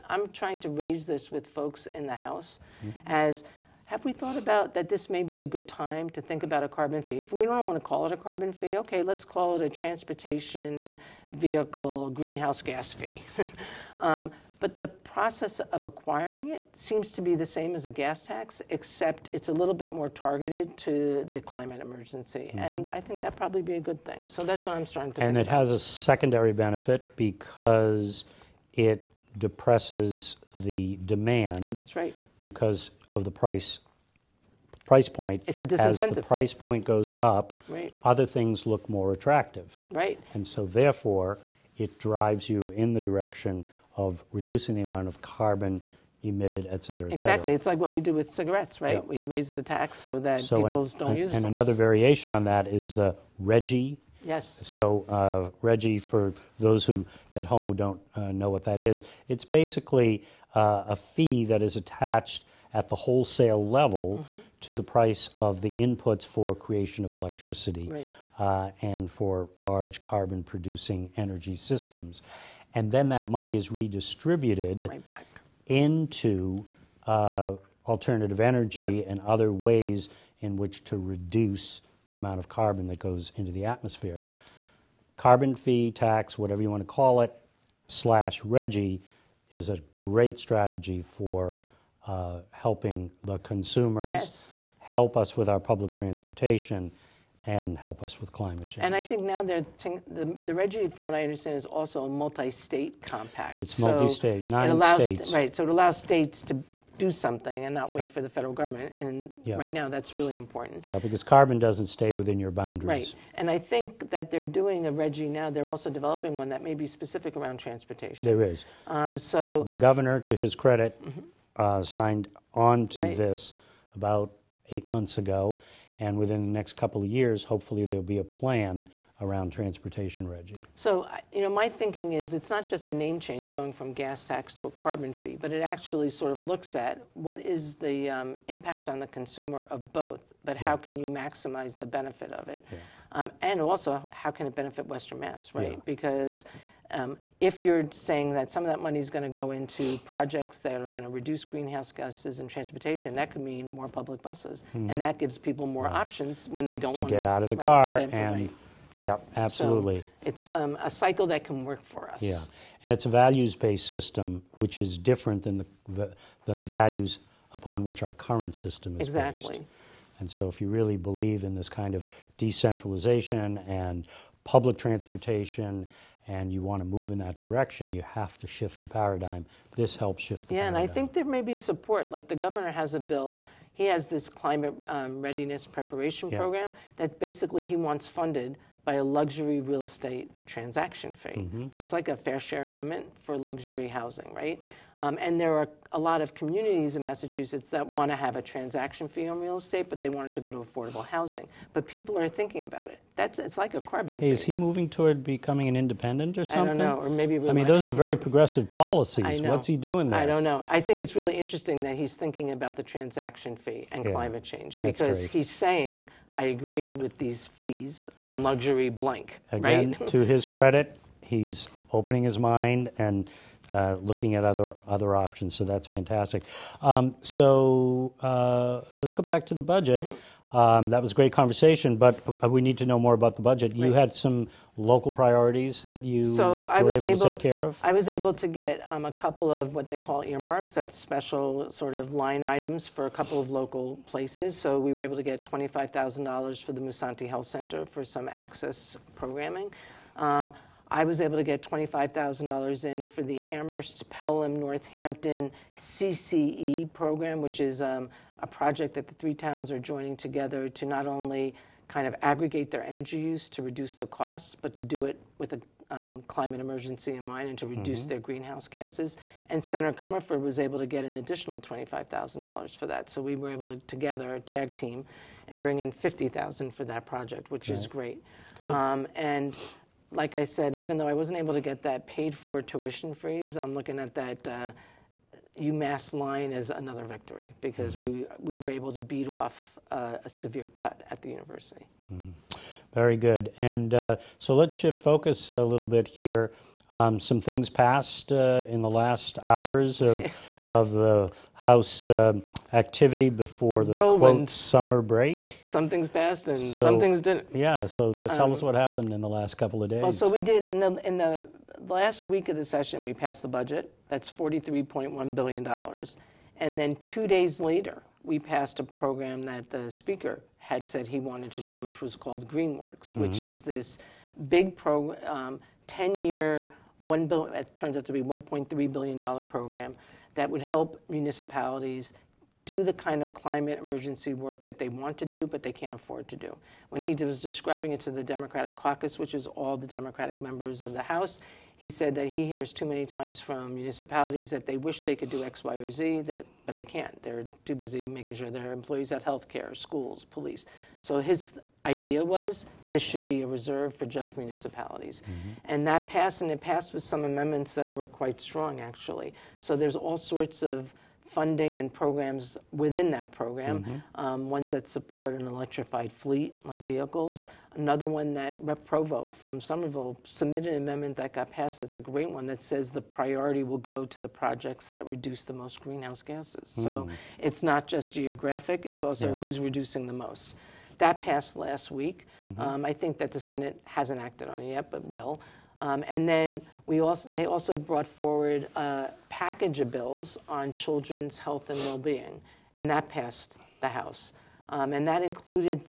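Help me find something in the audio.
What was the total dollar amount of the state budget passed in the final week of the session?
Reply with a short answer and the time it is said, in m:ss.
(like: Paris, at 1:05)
$43.1 billion, at 5:14.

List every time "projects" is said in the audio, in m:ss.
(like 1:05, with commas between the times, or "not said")
2:30, 4:18, 4:37, 6:14.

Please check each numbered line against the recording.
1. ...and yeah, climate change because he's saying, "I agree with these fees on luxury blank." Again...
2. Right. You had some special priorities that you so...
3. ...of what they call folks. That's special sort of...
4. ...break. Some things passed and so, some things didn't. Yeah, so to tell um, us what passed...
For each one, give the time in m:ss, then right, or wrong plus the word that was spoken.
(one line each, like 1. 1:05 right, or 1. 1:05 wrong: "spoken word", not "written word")
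1. 3:33 right
2. 3:53 wrong: "local", not "special"
3. 3:59 wrong: "earmarks", not "folks"
4. 5:05 wrong: "happened", not "passed".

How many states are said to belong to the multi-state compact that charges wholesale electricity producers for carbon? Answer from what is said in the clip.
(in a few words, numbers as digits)
9.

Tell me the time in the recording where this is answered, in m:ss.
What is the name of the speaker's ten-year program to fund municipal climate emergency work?
5:22.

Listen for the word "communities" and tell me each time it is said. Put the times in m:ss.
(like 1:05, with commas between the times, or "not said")
3:16.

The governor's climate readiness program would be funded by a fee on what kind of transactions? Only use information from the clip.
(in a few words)
luxury real estate.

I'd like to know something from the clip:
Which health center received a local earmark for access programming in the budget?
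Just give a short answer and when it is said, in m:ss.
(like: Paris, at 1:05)
Musanti Health Center, at 4:06.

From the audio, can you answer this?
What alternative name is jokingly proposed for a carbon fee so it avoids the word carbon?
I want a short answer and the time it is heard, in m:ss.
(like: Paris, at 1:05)
transportation vehicle greenhouse gas fee, at 0:09.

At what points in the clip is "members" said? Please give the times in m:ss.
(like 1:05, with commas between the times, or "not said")
5:40.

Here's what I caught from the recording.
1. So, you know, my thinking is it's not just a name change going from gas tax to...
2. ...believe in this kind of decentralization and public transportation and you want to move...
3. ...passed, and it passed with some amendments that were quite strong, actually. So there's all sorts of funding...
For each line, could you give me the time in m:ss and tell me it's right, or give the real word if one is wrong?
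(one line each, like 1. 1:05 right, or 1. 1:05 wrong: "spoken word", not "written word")
1. 2:10 right
2. 2:50 right
3. 5:56 right.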